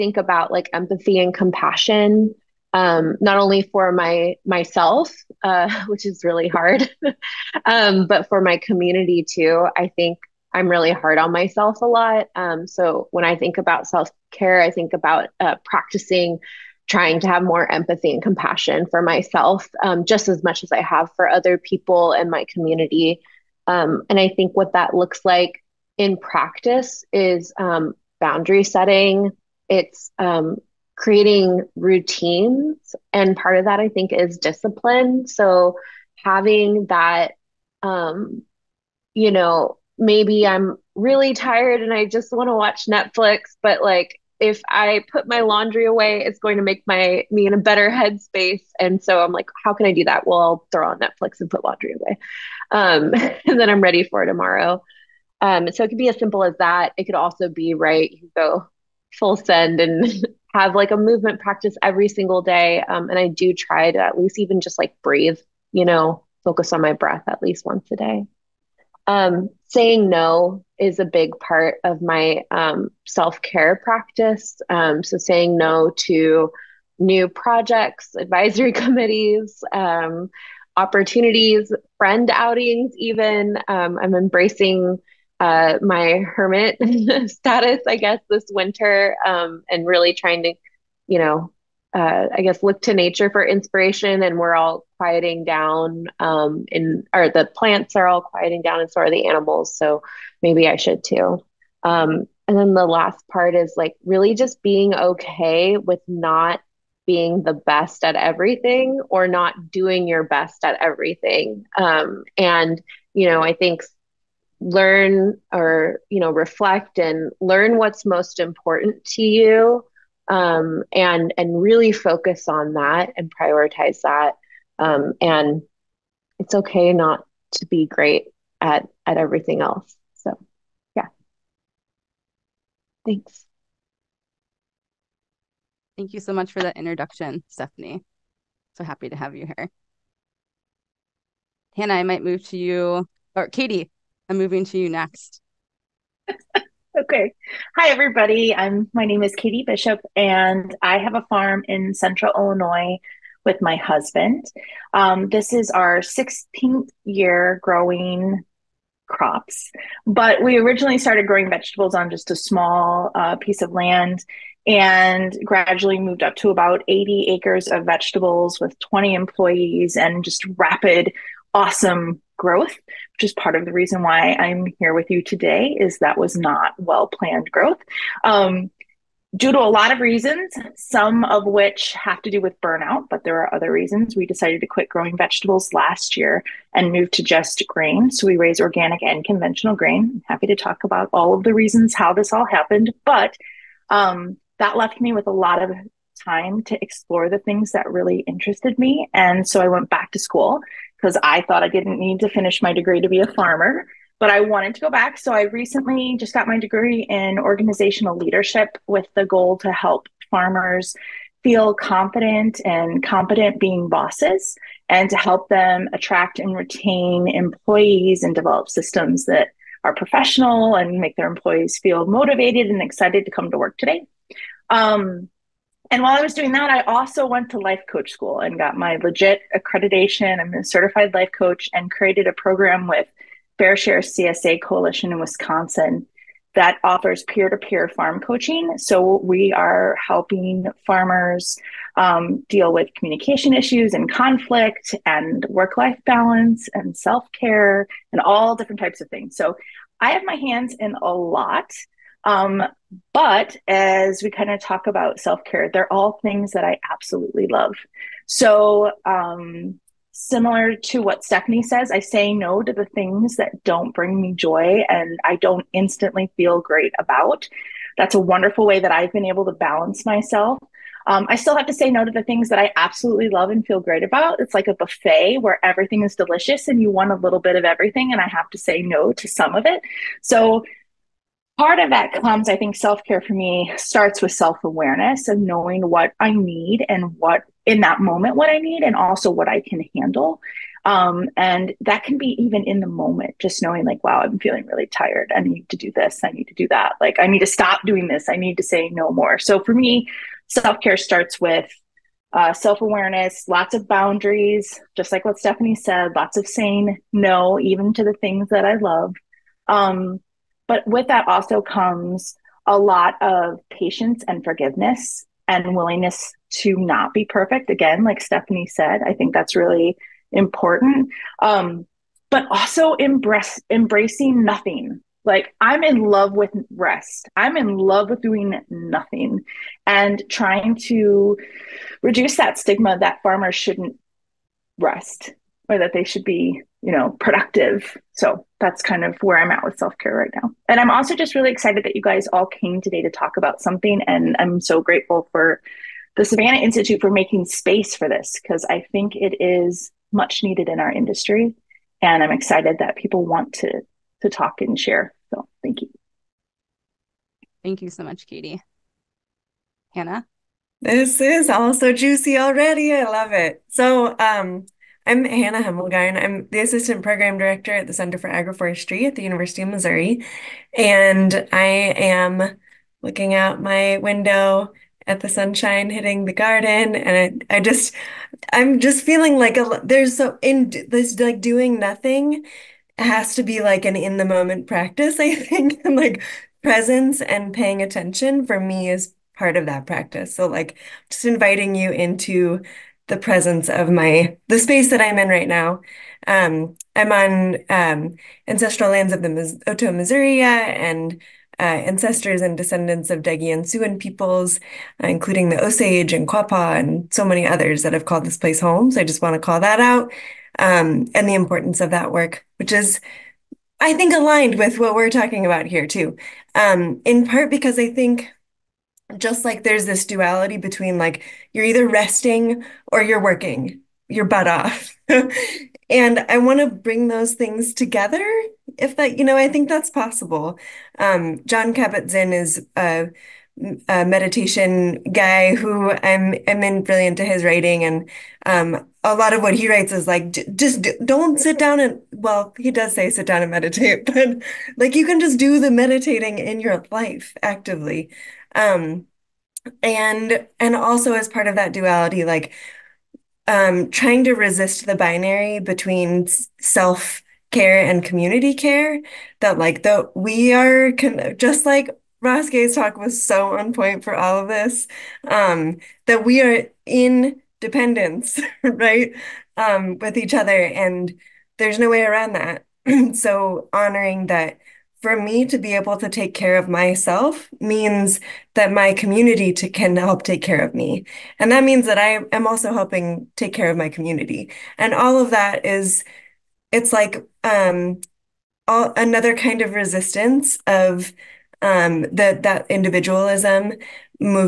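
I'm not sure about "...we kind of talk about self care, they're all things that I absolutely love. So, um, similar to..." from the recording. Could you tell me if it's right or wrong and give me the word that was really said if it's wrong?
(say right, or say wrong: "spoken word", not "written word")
right.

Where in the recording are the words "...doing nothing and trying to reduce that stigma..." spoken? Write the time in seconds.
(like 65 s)
328 s.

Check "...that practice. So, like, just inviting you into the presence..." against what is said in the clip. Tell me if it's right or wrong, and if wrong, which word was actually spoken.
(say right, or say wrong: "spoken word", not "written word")
right.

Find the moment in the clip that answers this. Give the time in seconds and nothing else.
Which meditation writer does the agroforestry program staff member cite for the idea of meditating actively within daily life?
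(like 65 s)
431 s.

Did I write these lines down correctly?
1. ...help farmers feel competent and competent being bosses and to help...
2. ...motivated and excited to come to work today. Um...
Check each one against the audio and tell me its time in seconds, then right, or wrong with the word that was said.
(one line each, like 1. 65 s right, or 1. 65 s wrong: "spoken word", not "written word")
1. 209 s wrong: "confident", not "competent"
2. 222 s right.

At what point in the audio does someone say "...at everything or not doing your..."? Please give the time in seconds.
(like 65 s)
108 s.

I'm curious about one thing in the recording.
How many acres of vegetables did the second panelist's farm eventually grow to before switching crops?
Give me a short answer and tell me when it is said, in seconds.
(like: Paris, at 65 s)
80, at 166 s.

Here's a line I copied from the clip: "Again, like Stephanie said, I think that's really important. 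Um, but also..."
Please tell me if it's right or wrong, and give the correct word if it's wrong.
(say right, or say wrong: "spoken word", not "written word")
right.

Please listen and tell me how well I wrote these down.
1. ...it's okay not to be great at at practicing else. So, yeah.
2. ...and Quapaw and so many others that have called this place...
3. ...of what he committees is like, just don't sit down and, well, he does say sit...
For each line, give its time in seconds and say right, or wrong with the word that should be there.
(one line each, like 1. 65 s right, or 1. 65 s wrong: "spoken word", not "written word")
1. 126 s wrong: "everything", not "practicing"
2. 406 s right
3. 439 s wrong: "writes", not "committees".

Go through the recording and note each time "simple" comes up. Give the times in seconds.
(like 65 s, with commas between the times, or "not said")
56 s.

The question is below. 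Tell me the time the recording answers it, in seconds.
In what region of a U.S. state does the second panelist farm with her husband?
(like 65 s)
151 s.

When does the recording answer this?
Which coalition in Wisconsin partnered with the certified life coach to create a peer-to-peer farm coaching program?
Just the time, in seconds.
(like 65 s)
233 s.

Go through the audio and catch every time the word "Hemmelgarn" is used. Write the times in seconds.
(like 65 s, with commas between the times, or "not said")
365 s.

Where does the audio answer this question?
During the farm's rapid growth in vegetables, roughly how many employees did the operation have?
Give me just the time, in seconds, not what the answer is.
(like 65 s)
168 s.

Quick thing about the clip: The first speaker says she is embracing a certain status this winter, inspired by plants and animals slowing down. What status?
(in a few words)
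hermit.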